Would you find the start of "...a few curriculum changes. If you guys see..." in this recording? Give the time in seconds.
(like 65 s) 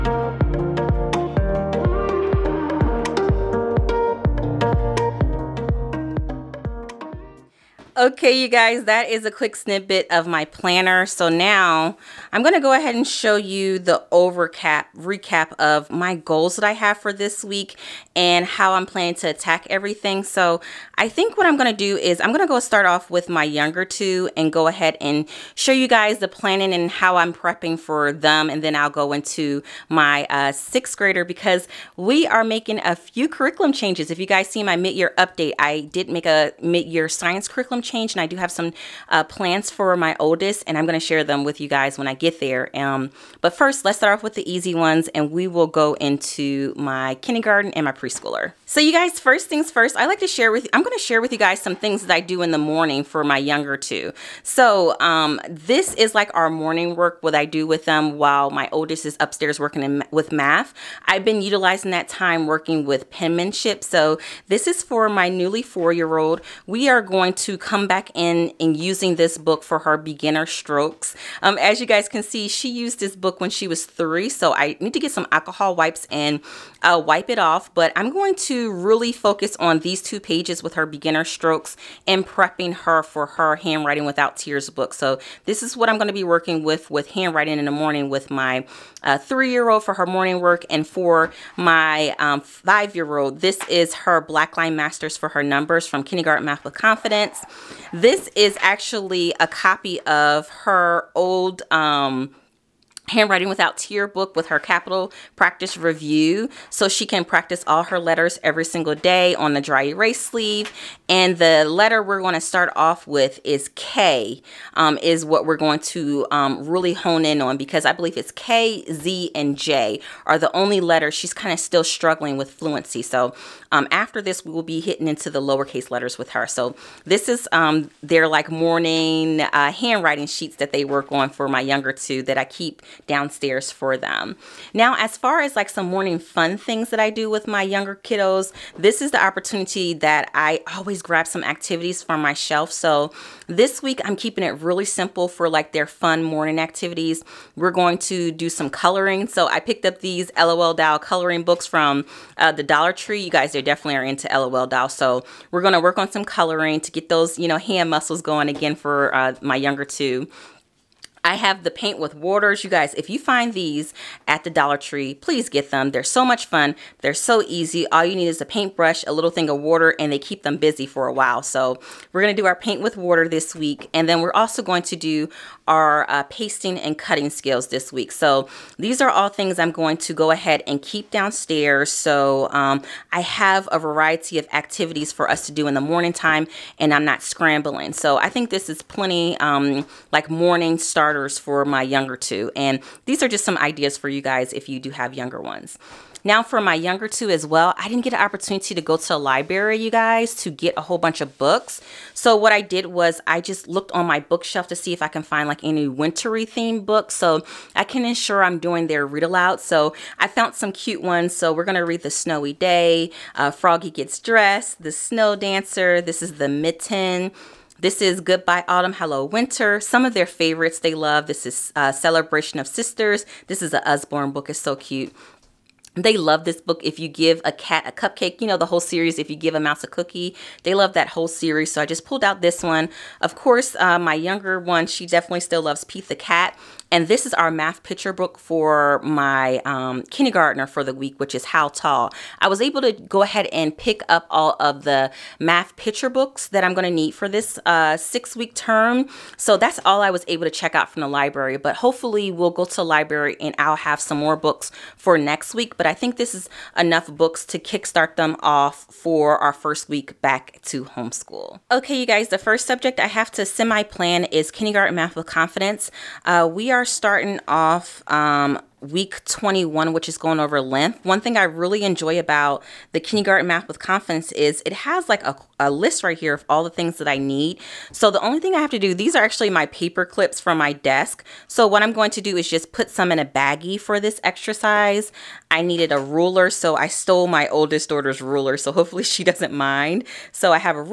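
32 s.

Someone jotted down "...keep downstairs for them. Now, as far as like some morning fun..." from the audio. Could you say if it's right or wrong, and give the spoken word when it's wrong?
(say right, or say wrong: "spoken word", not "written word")
right.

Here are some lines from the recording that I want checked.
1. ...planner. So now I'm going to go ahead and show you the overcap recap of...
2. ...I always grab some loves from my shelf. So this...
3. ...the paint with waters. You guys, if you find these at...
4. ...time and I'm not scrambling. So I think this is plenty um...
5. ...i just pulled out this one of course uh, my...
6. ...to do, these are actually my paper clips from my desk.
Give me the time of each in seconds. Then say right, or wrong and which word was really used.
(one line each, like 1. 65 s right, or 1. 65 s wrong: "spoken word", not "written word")
1. 10 s right
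2. 140 s wrong: "activities", not "loves"
3. 161 s right
4. 186 s right
5. 231 s right
6. 278 s right.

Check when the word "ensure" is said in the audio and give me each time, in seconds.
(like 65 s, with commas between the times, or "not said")
208 s.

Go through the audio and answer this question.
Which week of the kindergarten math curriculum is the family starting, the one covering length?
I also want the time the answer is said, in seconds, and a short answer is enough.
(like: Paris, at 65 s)
21, at 268 s.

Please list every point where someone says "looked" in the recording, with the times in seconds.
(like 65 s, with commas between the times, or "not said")
203 s.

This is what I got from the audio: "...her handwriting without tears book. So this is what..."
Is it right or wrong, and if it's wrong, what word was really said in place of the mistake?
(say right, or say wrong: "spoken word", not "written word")
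right.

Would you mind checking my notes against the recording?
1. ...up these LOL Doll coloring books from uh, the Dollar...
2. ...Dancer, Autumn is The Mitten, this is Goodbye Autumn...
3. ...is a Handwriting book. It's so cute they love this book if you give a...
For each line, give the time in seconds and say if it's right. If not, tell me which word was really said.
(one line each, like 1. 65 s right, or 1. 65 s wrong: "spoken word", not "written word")
1. 149 s right
2. 215 s wrong: "This", not "Autumn"
3. 223 s wrong: "Usborne", not "Handwriting".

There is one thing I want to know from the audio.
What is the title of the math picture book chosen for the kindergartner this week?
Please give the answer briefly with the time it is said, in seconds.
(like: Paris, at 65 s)
How Tall, at 241 s.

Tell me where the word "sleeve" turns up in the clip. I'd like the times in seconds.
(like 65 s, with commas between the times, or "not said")
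110 s.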